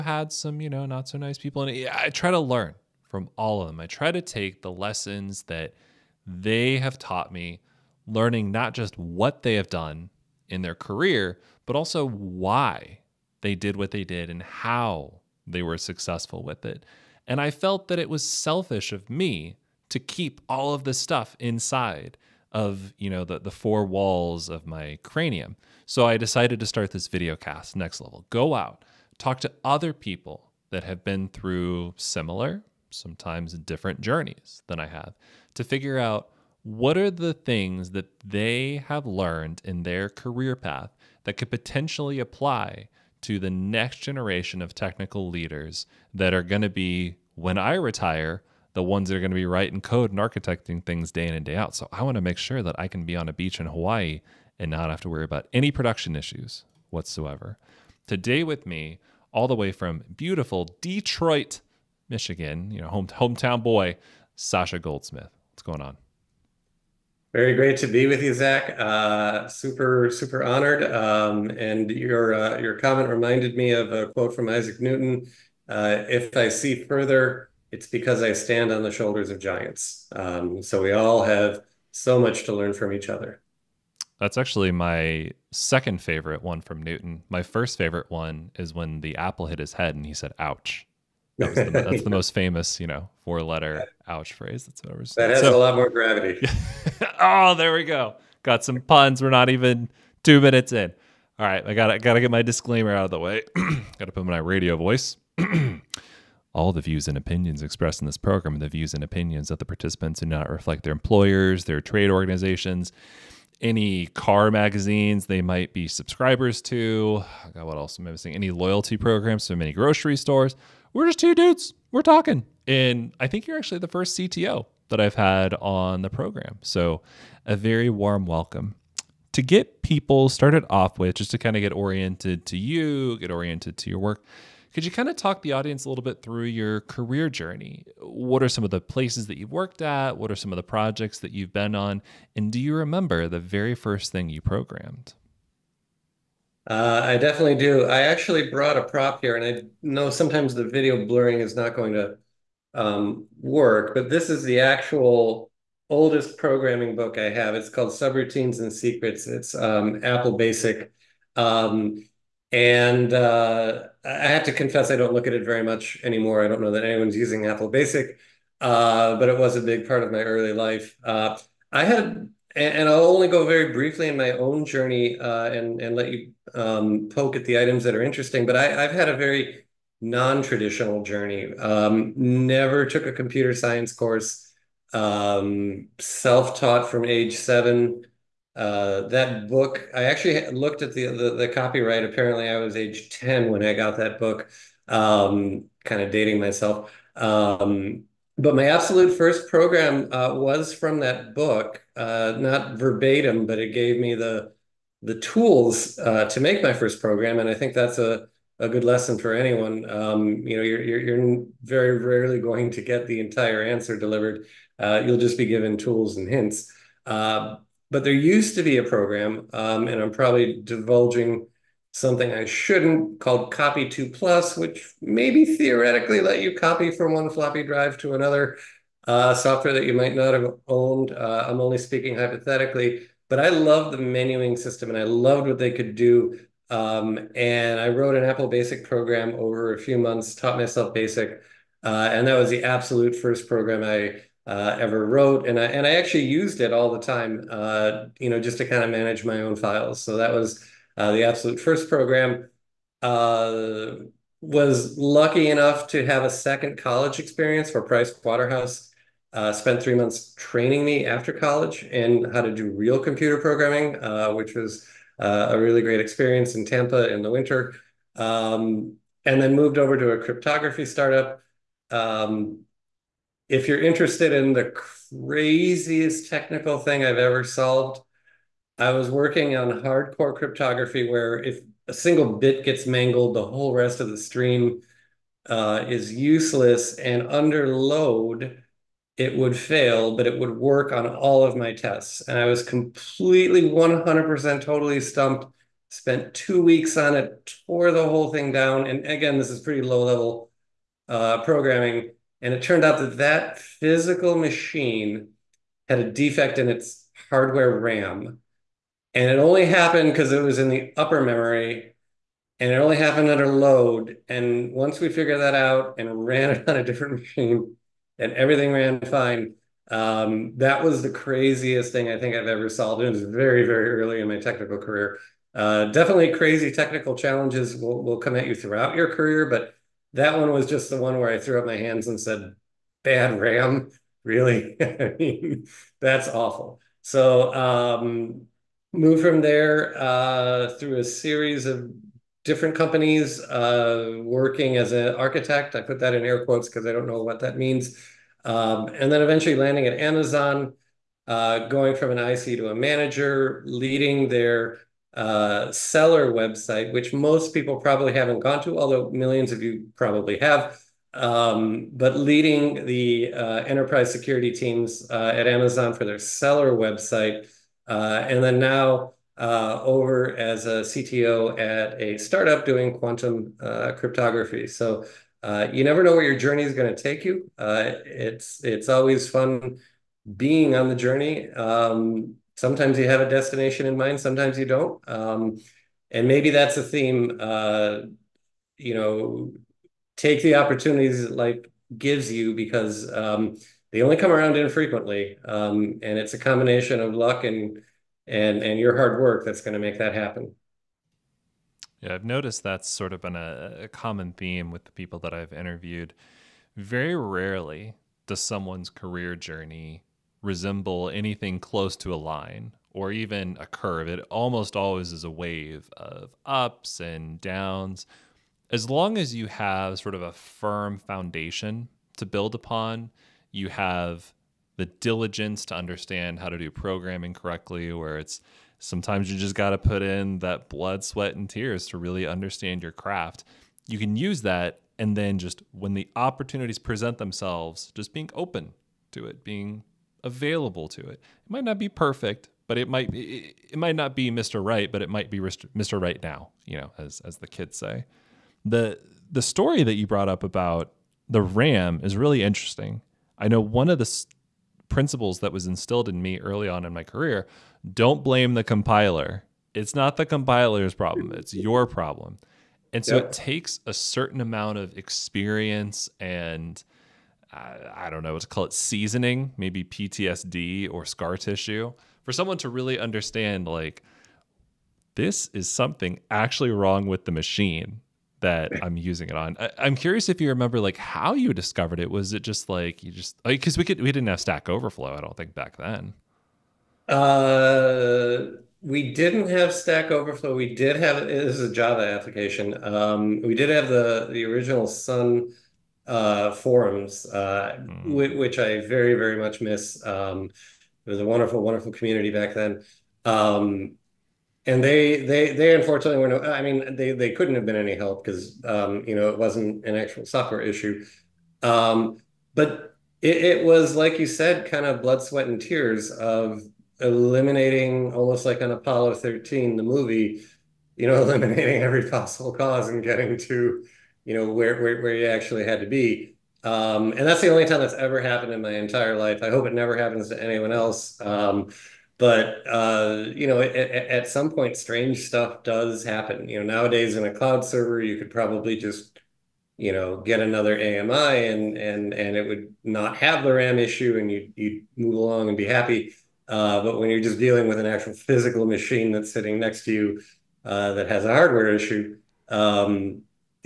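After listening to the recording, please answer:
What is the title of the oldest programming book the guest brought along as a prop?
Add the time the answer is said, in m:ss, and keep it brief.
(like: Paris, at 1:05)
Subroutines and Secrets, at 2:37.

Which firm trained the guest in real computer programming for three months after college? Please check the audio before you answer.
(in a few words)
Price Waterhouse.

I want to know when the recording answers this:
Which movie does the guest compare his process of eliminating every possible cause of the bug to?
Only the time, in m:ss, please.
8:38.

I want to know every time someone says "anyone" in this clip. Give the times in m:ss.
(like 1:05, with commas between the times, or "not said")
2:46, 3:29, 8:50.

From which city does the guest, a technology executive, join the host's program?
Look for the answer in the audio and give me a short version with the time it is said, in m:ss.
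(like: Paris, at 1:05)
Detroit, at 1:00.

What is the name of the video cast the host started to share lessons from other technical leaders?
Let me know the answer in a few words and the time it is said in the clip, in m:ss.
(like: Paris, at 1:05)
Next Level, at 0:27.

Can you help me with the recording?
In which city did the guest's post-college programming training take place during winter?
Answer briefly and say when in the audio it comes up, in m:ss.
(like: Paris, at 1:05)
Tampa, at 4:26.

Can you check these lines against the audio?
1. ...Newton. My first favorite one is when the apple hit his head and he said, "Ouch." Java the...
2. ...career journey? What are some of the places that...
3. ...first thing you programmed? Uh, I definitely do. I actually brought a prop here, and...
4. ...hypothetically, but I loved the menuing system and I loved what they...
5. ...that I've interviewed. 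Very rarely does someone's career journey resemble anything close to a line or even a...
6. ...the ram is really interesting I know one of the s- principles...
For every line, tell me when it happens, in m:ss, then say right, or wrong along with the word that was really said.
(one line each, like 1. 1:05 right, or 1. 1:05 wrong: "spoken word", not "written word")
1. 1:26 wrong: "That", not "Java"
2. 2:16 right
3. 2:23 right
4. 3:52 right
5. 6:45 right
6. 7:31 right.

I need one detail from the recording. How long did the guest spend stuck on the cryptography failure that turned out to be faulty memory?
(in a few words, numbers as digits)
two weeks.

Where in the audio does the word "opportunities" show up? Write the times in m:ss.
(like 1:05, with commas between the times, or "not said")
6:30, 7:16.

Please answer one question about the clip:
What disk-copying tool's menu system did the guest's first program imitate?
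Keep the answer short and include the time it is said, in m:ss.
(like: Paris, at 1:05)
Copy 2 Plus, at 3:43.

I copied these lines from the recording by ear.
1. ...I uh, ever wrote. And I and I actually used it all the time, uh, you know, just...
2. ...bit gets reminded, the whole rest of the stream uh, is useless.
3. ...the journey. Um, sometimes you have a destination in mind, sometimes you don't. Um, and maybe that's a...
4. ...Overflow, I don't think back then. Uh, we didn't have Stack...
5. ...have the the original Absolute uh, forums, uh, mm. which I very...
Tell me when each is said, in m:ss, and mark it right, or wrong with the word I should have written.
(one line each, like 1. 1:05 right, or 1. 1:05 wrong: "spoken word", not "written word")
1. 4:03 right
2. 4:42 wrong: "mangled", not "reminded"
3. 6:20 right
4. 8:04 right
5. 8:13 wrong: "Sun", not "Absolute".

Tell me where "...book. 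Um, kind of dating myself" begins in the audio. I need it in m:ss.
3:14.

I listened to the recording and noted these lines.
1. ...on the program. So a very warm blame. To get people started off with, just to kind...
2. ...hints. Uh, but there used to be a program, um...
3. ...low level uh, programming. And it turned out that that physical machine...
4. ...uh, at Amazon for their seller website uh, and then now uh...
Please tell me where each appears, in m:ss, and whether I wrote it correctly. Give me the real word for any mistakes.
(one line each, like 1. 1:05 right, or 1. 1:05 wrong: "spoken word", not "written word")
1. 2:05 wrong: "welcome", not "blame"
2. 3:36 right
3. 4:59 right
4. 6:05 right.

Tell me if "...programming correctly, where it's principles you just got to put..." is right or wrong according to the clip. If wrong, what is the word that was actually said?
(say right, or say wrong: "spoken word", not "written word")
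wrong: "sometimes", not "principles".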